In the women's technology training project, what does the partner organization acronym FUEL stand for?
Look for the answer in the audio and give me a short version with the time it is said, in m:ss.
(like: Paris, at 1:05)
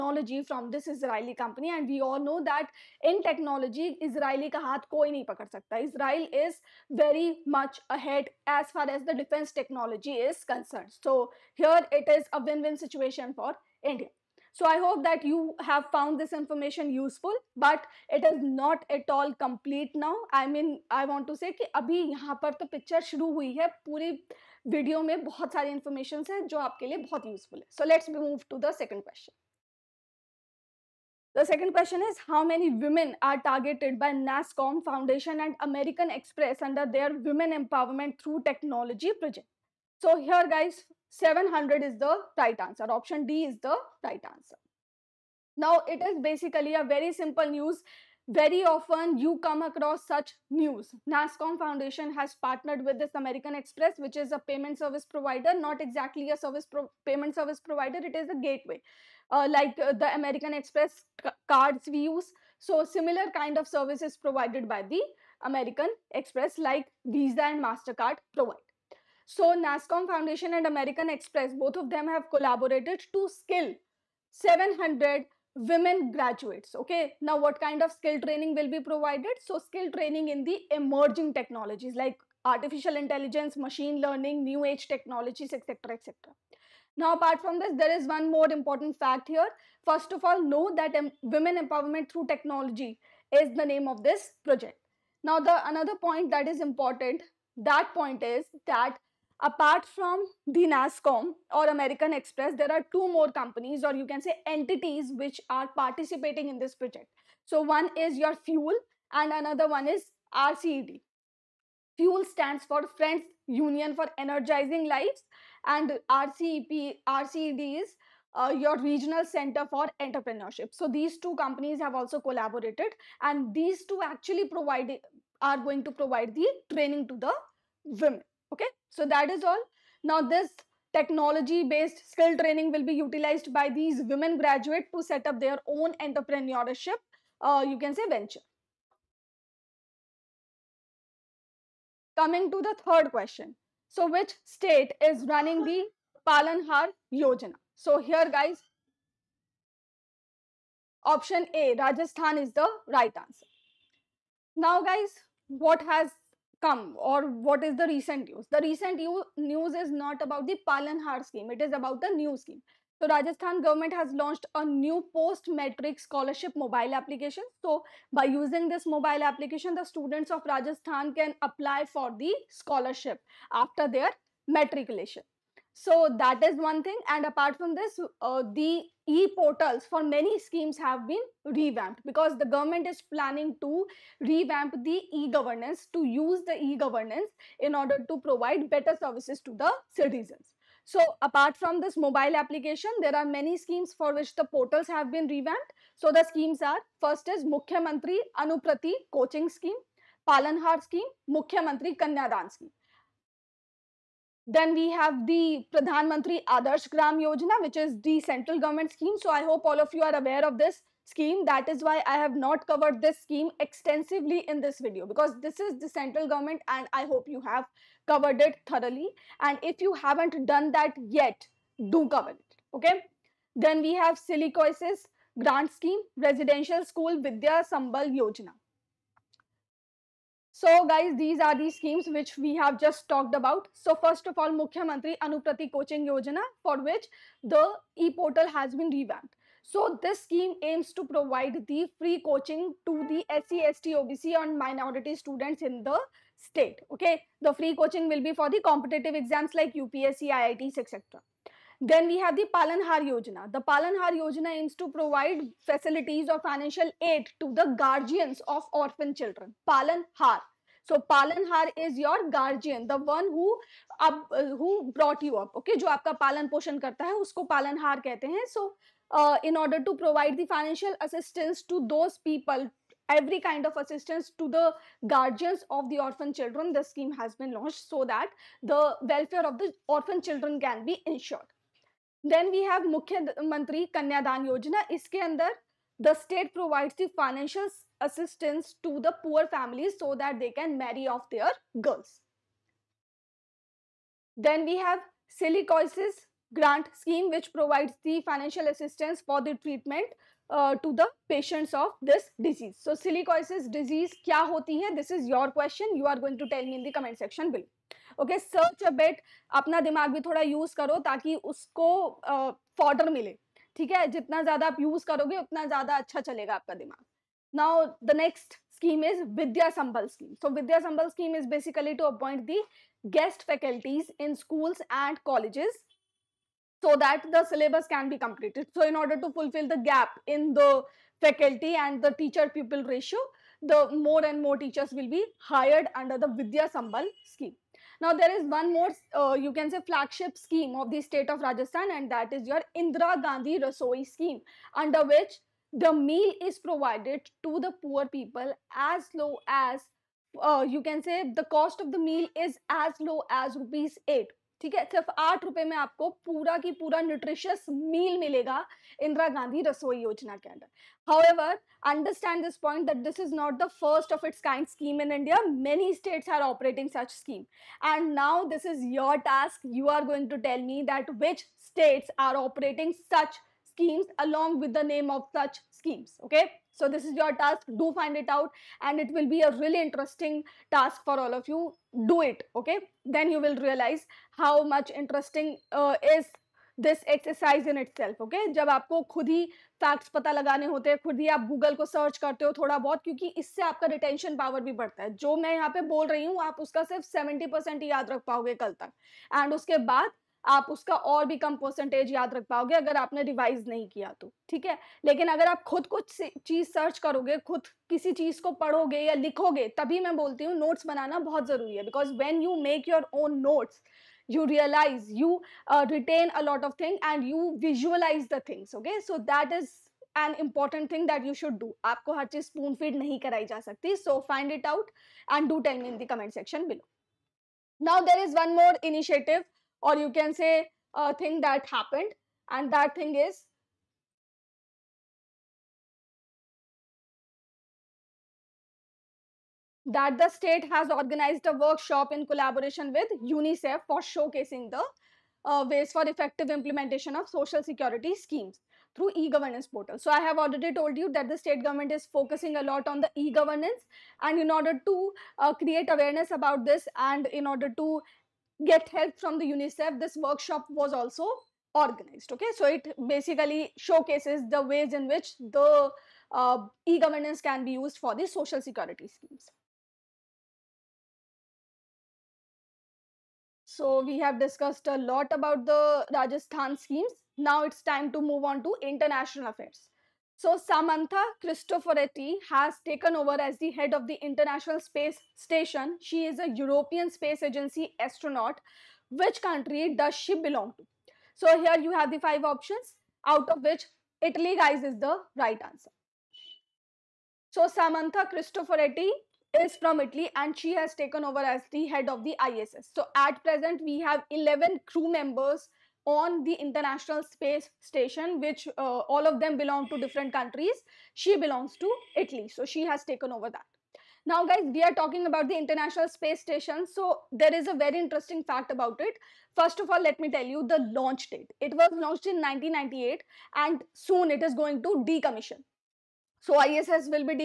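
Friends Union for Energizing Lives, at 1:52.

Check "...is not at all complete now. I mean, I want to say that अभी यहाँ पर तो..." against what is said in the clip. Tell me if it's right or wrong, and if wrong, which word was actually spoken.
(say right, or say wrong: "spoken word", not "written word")
right.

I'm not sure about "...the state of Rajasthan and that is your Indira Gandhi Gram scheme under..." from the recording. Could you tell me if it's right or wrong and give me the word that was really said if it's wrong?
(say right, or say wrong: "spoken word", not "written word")
wrong: "Rasoi", not "Gram".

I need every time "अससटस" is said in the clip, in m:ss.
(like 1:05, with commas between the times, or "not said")
4:48, 4:58.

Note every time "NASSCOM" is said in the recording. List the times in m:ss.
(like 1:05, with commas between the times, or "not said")
0:51, 1:09, 1:40.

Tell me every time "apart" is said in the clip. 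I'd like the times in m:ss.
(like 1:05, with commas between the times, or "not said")
1:27, 1:39, 2:57, 3:11.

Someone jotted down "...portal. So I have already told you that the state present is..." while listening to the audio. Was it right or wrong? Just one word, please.
wrong.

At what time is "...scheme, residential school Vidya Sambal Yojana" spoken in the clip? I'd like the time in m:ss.
3:45.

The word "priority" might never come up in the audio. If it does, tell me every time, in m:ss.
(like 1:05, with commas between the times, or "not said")
not said.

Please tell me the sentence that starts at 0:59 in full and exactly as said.
Uh, like uh, the American Express cards we use.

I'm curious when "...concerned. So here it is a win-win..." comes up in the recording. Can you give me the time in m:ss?
0:10.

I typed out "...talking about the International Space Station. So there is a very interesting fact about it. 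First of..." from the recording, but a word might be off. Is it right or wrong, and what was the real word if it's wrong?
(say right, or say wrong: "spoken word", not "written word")
right.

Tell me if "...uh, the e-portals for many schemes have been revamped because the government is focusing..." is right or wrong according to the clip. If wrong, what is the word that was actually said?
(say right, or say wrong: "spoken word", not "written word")
wrong: "planning", not "focusing".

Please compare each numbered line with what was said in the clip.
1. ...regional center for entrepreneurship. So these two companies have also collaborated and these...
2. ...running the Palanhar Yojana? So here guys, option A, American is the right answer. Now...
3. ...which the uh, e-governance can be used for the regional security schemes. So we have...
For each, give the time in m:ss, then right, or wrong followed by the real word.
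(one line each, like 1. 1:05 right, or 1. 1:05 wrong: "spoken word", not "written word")
1. 1:58 right
2. 2:25 wrong: "Rajasthan", not "American"
3. 7:45 wrong: "social", not "regional".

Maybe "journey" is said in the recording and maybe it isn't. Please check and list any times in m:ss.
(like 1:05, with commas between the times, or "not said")
not said.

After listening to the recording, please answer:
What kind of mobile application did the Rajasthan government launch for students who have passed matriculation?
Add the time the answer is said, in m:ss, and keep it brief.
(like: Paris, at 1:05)
post-matric scholarship, at 2:45.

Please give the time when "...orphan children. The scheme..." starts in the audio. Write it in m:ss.
4:35.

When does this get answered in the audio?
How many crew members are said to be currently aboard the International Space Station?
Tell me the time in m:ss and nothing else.
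8:24.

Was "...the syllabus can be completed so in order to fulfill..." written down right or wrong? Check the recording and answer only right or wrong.
right.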